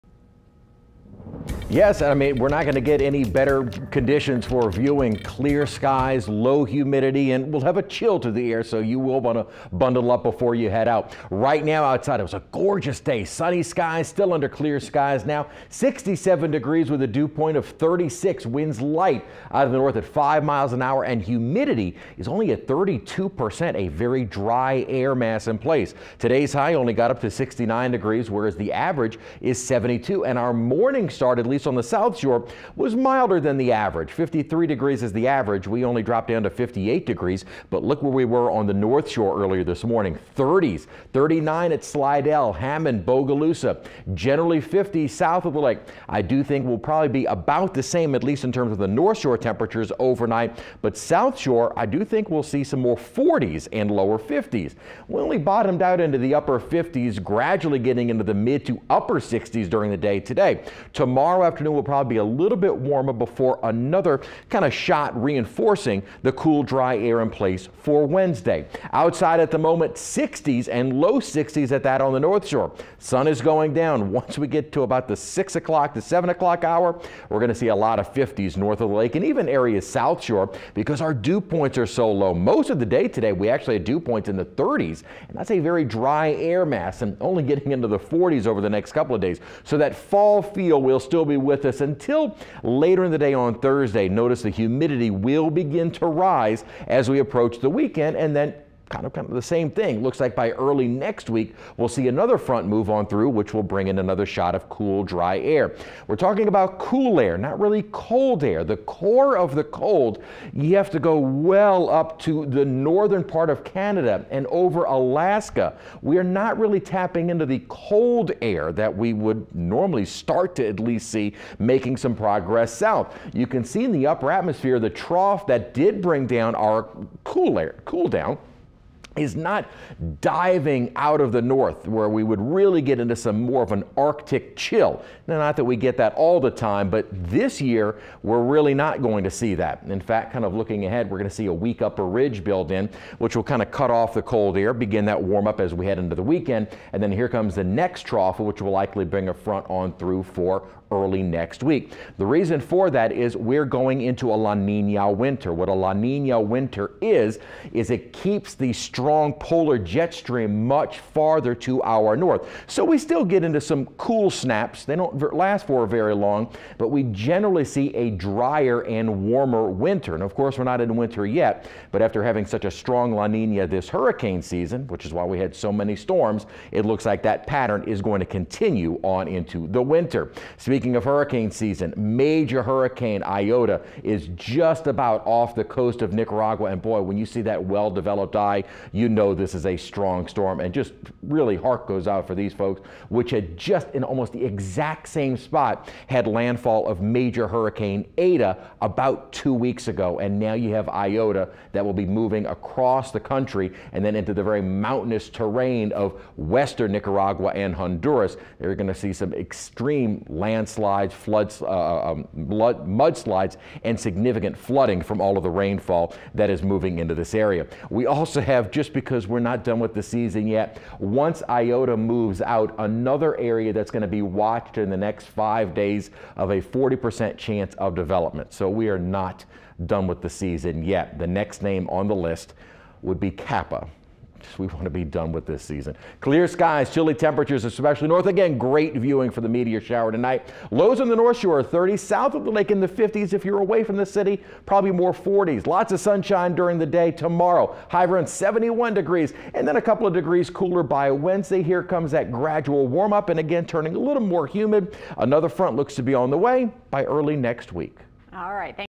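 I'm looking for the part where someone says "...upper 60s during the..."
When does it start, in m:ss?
0:58.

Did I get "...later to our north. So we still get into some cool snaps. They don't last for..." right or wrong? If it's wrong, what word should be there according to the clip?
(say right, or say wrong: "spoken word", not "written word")
wrong: "farther", not "later".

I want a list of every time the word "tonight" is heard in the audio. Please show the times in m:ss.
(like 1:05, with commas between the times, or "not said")
4:00.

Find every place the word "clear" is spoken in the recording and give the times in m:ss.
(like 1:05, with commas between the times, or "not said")
0:05, 0:14, 3:56.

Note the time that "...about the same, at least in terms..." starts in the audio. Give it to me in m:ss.
0:47.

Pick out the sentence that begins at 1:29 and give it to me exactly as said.
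So that fall feel will still be with us until later in the day on Thursday.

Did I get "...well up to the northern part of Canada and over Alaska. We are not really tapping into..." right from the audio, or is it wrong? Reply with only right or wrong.
right.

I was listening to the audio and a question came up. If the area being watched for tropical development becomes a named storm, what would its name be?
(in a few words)
Kappa.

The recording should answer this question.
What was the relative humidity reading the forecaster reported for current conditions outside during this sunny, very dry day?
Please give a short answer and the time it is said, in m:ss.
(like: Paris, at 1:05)
32%, at 0:22.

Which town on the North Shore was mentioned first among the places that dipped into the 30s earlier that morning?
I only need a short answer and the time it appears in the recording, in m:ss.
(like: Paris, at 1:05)
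Slidell, at 0:41.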